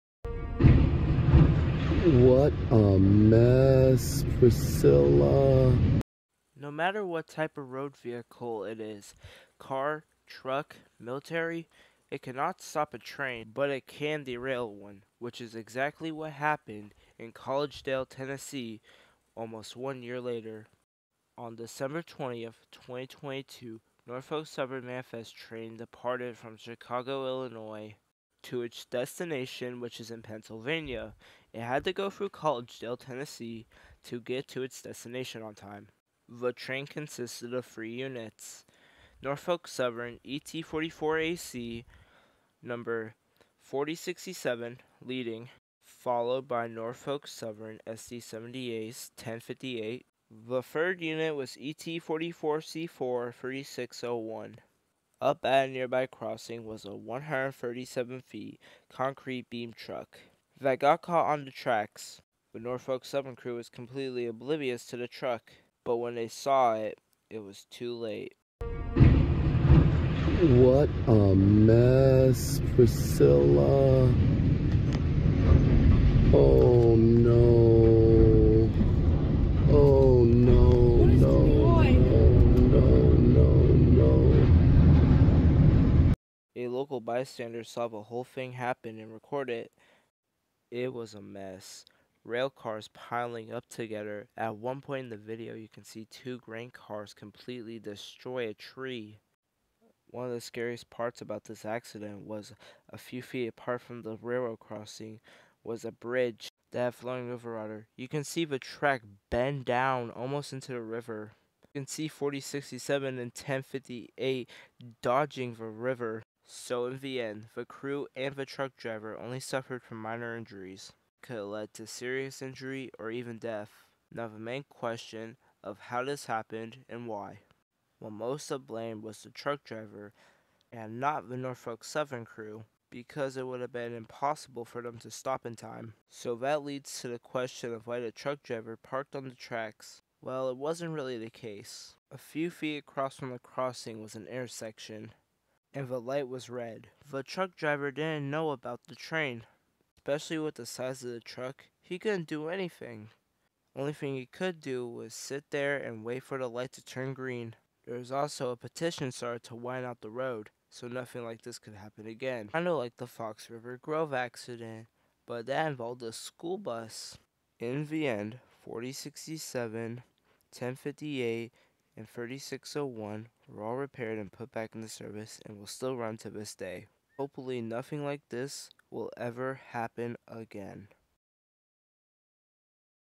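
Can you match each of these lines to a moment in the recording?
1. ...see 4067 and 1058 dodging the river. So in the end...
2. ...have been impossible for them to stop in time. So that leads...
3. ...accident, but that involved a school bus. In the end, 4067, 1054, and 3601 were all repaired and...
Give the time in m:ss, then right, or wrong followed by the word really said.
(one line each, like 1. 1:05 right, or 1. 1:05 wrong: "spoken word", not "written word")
1. 1:51 right
2. 2:13 right
3. 2:44 wrong: "1058", not "1054".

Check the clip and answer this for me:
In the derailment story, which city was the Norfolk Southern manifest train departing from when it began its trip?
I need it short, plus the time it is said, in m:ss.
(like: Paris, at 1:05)
Chicago, Illinois, at 0:26.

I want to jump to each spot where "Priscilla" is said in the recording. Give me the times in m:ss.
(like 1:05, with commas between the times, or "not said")
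0:04, 1:12.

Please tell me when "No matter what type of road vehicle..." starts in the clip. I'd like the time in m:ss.
0:06.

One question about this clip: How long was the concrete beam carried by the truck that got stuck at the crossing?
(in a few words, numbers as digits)
137 feet.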